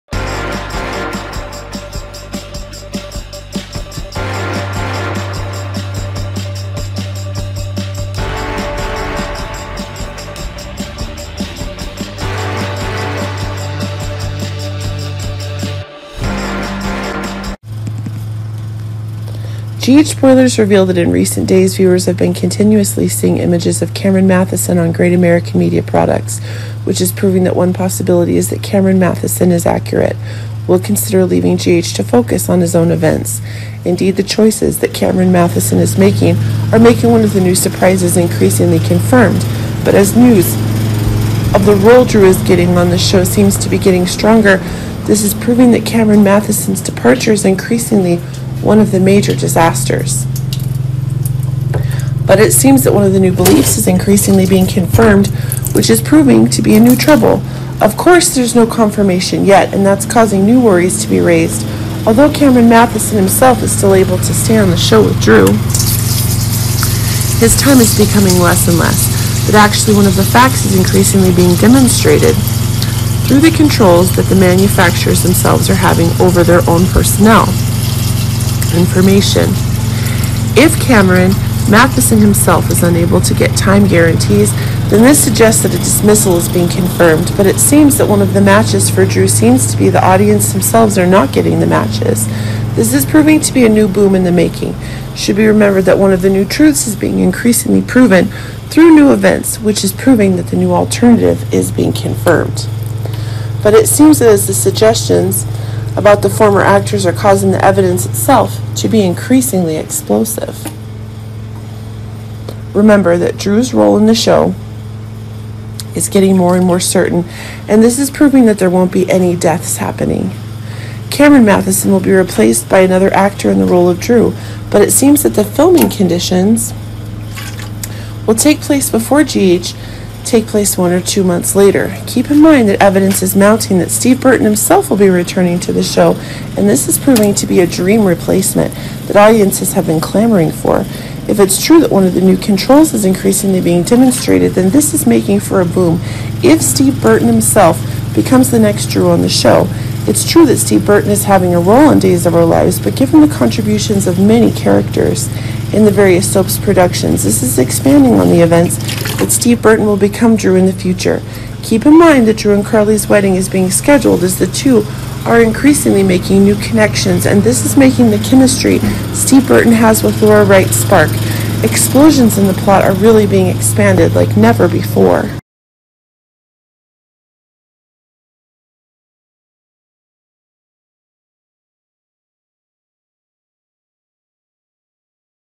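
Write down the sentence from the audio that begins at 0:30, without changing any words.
Will consider leaving GH to focus on his own events.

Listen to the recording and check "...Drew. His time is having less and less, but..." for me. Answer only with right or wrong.
wrong.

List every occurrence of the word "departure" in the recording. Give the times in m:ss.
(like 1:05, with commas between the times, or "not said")
0:46.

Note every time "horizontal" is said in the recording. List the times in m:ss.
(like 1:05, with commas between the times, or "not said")
not said.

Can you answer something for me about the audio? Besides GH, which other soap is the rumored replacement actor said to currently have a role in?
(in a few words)
Days of Our Lives.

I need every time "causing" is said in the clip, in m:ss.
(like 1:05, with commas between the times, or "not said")
1:00, 1:47.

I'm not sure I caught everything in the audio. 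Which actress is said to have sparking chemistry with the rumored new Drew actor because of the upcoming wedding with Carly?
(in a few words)
Laura Wright.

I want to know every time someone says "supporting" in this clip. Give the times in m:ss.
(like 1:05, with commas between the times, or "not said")
not said.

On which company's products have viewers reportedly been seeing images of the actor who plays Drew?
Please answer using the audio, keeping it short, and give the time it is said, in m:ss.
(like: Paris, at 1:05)
Great American Media, at 0:24.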